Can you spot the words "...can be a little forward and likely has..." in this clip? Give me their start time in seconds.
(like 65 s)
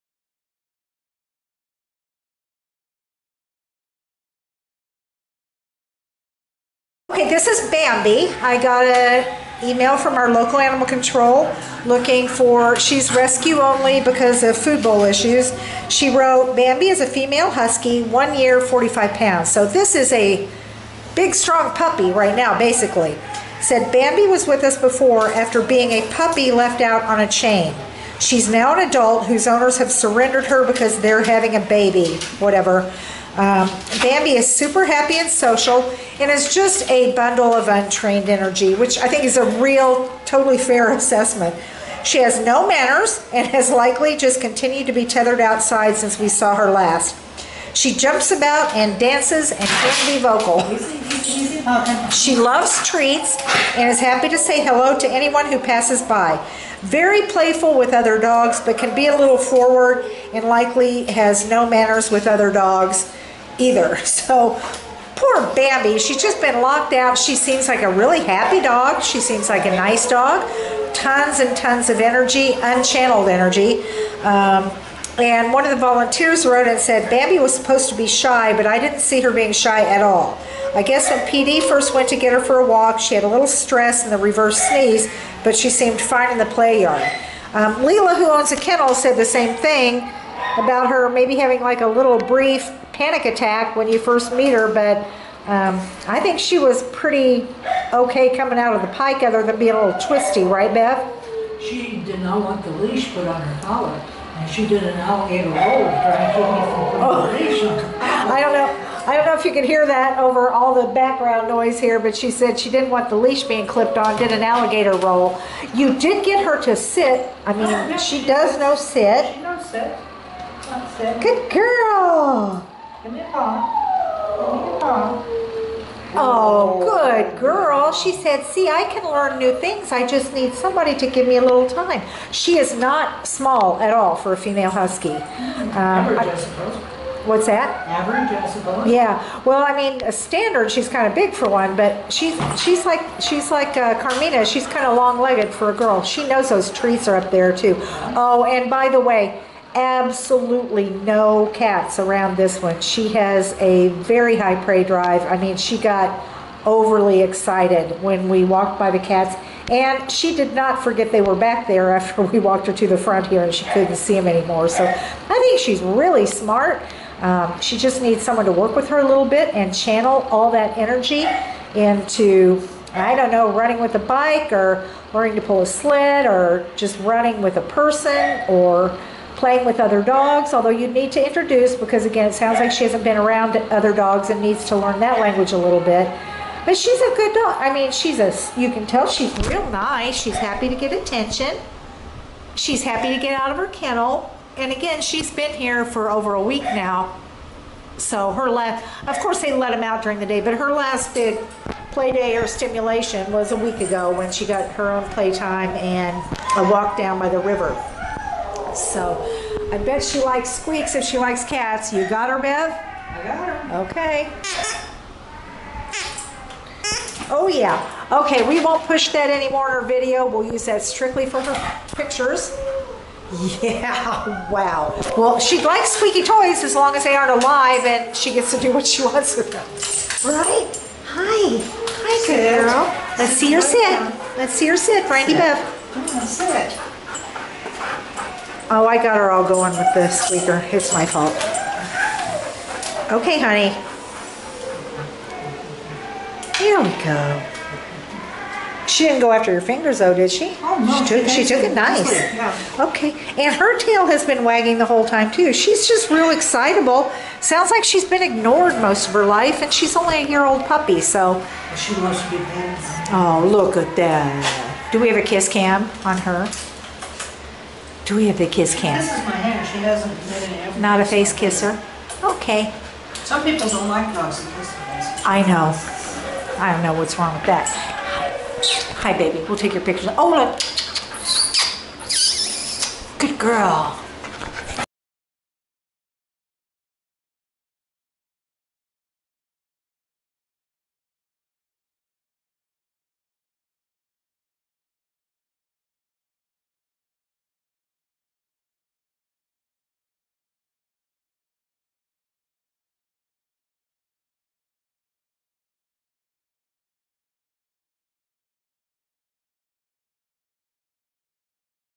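58 s.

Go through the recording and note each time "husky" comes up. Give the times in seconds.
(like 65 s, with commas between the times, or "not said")
17 s, 134 s.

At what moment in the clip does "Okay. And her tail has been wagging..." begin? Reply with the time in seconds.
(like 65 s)
252 s.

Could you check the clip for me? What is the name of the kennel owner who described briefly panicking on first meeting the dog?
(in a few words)
Leela.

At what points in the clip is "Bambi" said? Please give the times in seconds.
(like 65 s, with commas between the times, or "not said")
7 s, 16 s, 23 s, 34 s, 65 s, 77 s.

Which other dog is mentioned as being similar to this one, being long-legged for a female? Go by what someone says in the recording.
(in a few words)
Carmina.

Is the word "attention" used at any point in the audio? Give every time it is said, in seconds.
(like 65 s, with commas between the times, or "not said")
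190 s.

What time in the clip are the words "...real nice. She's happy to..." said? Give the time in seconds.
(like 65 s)
189 s.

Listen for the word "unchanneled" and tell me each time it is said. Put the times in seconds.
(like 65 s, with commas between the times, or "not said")
72 s.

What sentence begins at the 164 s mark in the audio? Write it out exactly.
So I think she's really smart.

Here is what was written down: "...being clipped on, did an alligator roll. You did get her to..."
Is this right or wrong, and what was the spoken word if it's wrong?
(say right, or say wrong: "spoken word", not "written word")
right.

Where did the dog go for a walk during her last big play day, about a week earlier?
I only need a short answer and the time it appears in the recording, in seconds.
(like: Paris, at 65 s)
down by the river, at 206 s.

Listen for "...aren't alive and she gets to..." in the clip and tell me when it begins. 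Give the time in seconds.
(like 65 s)
227 s.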